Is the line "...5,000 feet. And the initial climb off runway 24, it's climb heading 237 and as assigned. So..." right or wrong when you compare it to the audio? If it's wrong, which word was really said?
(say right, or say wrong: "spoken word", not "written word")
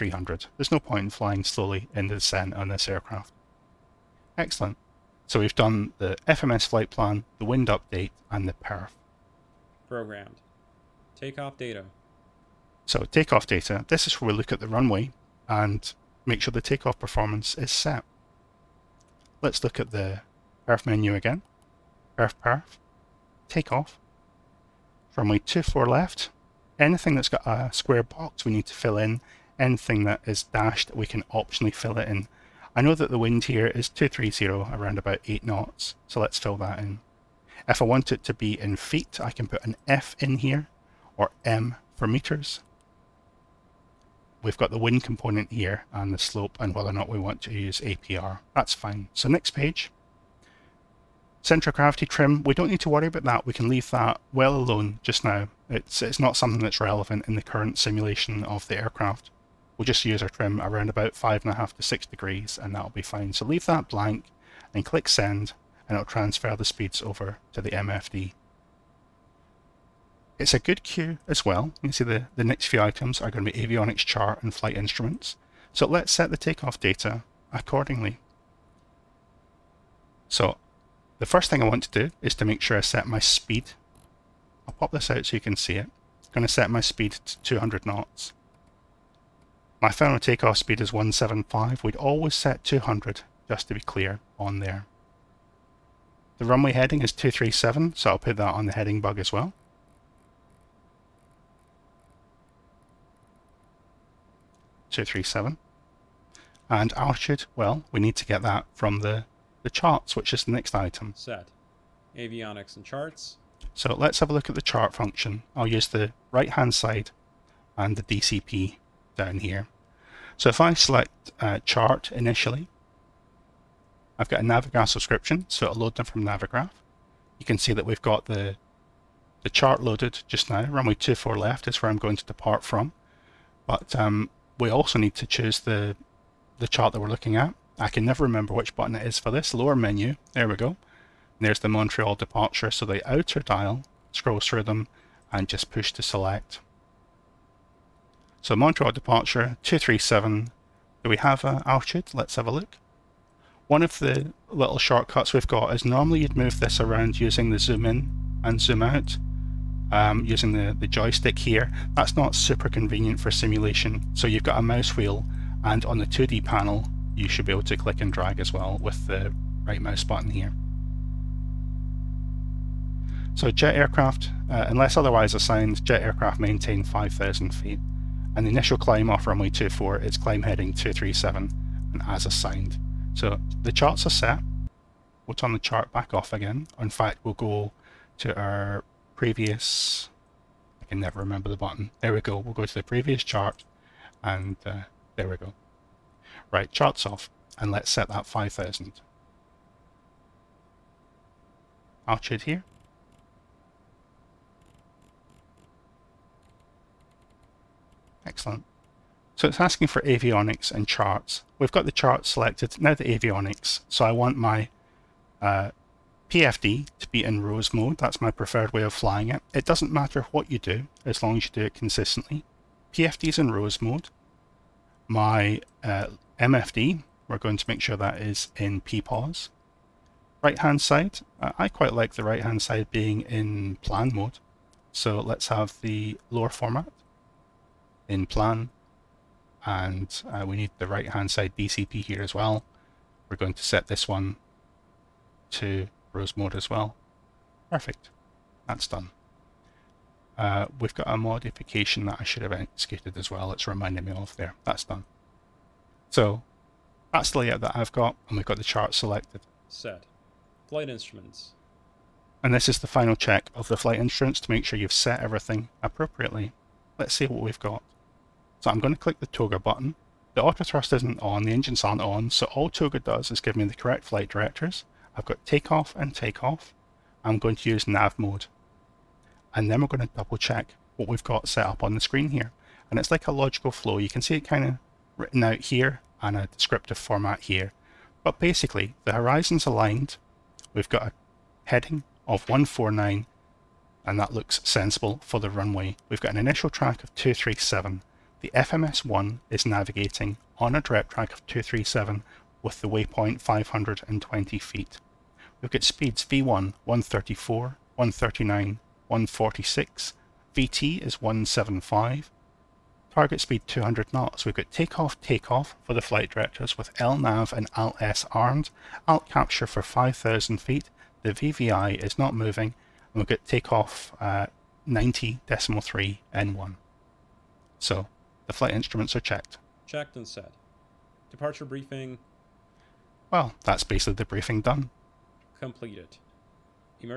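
right.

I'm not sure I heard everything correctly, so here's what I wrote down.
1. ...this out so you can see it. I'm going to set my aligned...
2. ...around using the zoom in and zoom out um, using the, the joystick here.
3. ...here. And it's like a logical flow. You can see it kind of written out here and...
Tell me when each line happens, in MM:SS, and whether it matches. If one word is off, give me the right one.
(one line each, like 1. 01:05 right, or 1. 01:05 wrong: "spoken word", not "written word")
1. 01:24 wrong: "speed", not "aligned"
2. 02:36 right
3. 04:42 right.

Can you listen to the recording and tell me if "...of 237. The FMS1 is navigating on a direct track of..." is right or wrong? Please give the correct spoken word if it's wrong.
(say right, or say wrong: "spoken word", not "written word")
right.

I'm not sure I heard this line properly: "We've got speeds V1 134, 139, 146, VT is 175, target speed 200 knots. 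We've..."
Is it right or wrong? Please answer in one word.
right.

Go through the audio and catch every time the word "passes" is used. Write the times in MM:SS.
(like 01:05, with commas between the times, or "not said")
not said.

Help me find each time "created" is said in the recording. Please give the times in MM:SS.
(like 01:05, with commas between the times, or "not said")
not said.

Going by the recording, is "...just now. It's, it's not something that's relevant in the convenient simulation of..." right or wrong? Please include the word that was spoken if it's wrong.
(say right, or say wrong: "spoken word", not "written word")
wrong: "current", not "convenient".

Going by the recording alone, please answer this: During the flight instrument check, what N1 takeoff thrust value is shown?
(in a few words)
90.3.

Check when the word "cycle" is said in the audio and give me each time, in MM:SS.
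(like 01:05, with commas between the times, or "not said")
not said.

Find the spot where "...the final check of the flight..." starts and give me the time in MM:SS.
04:22.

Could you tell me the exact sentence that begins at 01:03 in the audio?
So leave that blank and click send and it'll transfer the speeds over to the MFD.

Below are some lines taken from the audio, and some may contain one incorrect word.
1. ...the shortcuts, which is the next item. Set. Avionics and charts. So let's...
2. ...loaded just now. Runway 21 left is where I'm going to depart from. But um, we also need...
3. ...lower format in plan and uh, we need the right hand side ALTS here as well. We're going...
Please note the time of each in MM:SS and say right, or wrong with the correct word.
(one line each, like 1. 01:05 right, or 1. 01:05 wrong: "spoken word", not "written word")
1. 01:49 wrong: "charts", not "shortcuts"
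2. 02:09 wrong: "24", not "21"
3. 03:56 wrong: "DCP", not "ALTS".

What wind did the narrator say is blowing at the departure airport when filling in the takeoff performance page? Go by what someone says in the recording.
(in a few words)
230 at 8 knots.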